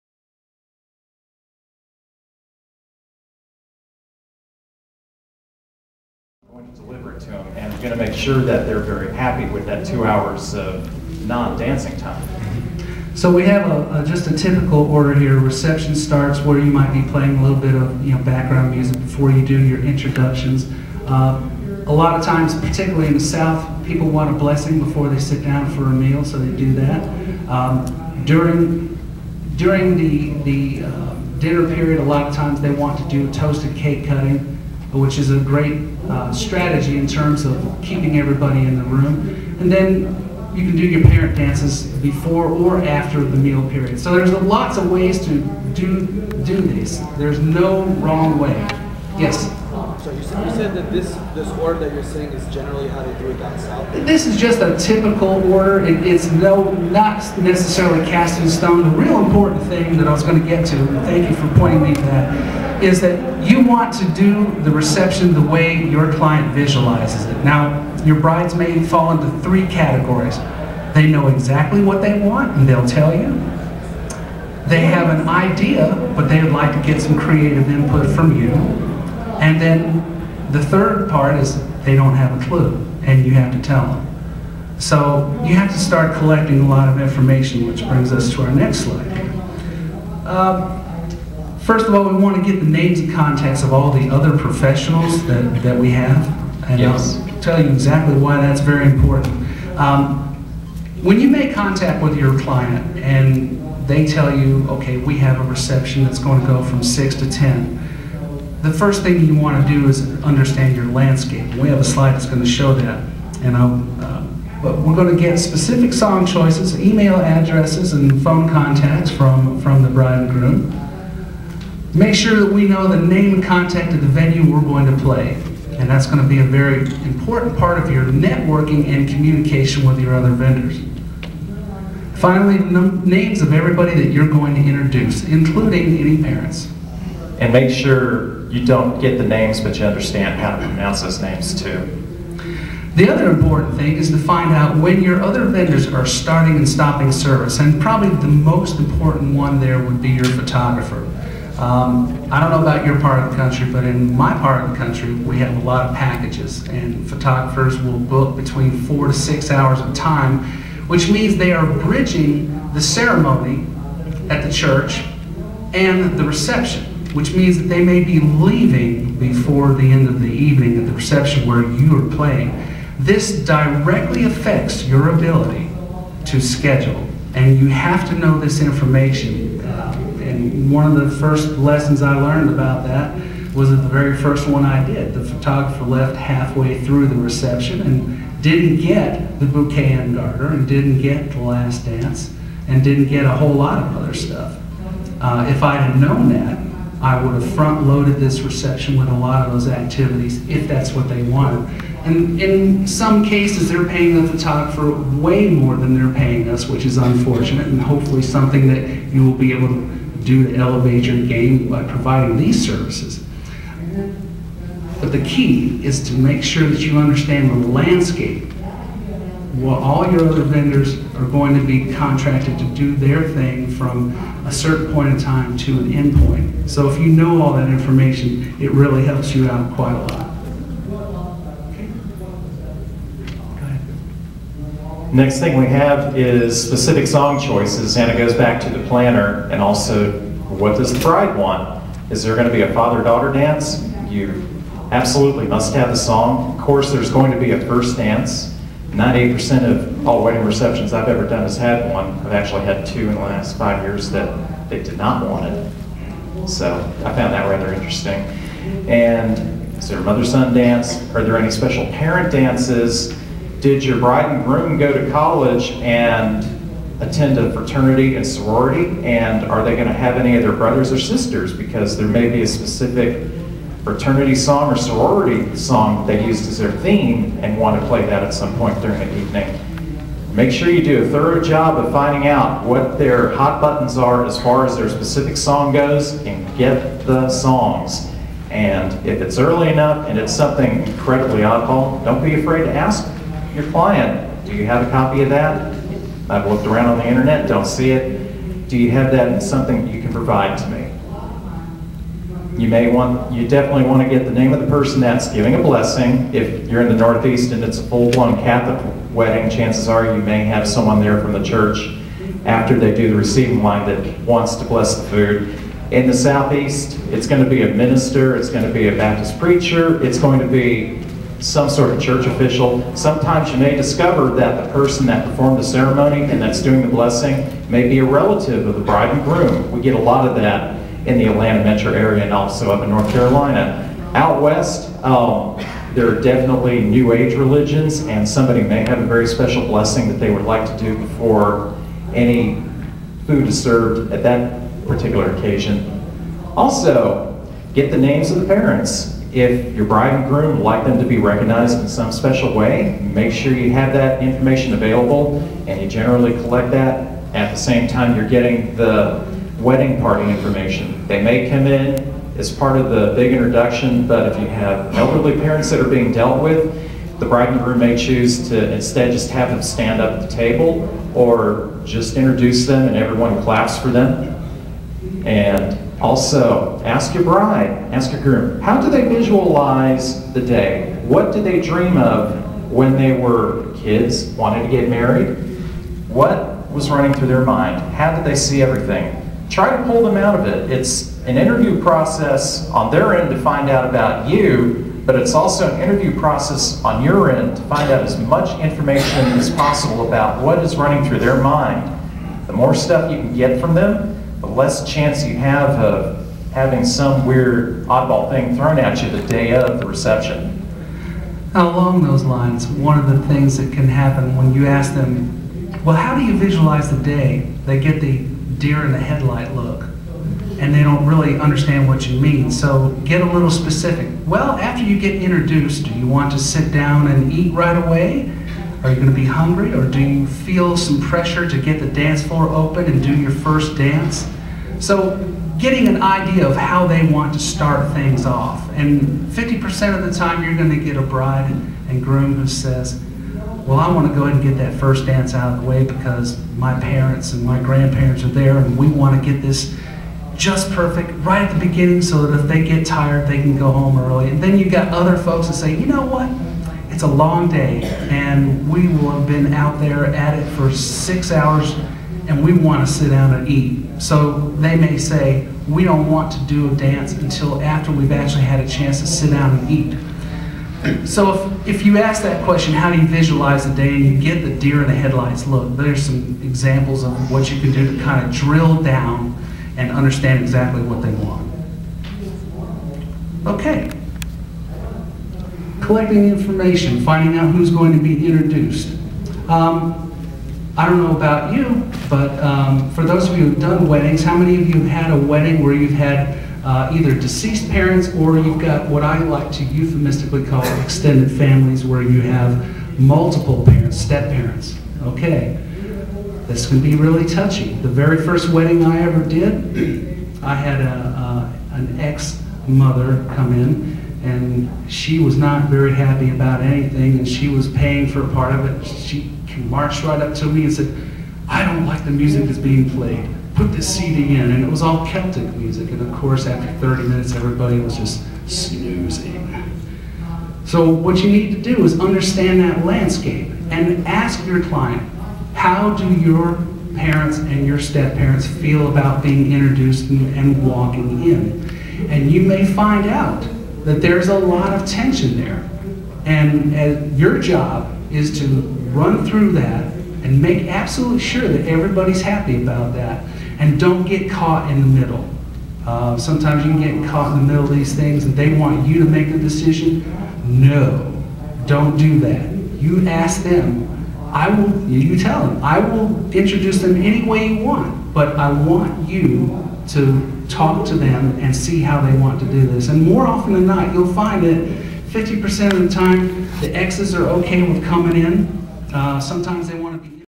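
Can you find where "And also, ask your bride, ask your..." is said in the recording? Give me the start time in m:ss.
6:15.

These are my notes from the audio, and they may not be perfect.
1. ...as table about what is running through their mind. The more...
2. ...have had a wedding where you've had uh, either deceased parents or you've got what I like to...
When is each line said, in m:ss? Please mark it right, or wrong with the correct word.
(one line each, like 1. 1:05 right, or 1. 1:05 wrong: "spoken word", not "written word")
1. 6:39 wrong: "possible", not "table"
2. 8:14 right.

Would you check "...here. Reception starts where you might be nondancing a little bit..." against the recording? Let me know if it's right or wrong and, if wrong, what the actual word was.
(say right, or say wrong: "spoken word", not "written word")
wrong: "playing", not "nondancing".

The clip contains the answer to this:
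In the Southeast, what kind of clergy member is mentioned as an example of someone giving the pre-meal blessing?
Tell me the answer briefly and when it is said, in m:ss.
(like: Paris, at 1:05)
Baptist preacher, at 5:18.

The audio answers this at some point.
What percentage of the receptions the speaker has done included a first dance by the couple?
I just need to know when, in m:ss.
4:08.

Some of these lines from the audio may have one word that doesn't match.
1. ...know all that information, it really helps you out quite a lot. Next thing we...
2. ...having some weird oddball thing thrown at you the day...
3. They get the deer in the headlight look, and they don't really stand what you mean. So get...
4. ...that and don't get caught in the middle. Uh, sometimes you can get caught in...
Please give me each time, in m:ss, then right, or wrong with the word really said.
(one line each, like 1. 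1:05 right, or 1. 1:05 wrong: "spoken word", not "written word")
1. 3:47 right
2. 6:46 right
3. 6:57 wrong: "understand", not "stand"
4. 9:12 right.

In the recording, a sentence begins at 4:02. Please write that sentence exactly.
Is there going to be a father-daughter dance?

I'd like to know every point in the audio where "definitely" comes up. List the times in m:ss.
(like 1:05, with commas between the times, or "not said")
5:03, 5:36.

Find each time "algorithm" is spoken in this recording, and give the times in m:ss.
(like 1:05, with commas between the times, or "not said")
not said.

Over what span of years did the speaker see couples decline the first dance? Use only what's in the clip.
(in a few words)
5 years.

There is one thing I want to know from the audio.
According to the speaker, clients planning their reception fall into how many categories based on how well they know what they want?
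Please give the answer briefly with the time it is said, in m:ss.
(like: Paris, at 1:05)
3, at 1:09.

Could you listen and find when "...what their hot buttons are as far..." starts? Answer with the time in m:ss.
4:42.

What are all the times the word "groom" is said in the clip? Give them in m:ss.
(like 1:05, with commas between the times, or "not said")
2:00, 4:24, 5:29, 5:50, 6:07, 6:18, 7:22.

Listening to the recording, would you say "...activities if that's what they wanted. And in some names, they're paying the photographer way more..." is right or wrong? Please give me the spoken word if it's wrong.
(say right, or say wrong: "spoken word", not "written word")
wrong: "cases", not "names".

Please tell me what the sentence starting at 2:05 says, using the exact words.
And that's going to be a very important part of your networking and communication with your other vendors.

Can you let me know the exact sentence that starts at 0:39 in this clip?
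And then you can do your parent dances before or after the meal period.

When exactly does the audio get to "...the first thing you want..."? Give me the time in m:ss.
1:48.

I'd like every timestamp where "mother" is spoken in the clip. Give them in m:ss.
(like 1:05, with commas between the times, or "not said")
4:20, 8:32.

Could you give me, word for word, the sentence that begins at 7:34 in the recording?
And then you've got other folks that say, you know what?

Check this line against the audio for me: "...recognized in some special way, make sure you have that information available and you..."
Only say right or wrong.
right.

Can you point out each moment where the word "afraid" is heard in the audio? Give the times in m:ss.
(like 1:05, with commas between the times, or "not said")
4:52.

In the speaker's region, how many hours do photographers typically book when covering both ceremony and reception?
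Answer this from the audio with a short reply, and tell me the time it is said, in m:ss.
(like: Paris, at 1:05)
4 to 6 hours, at 2:38.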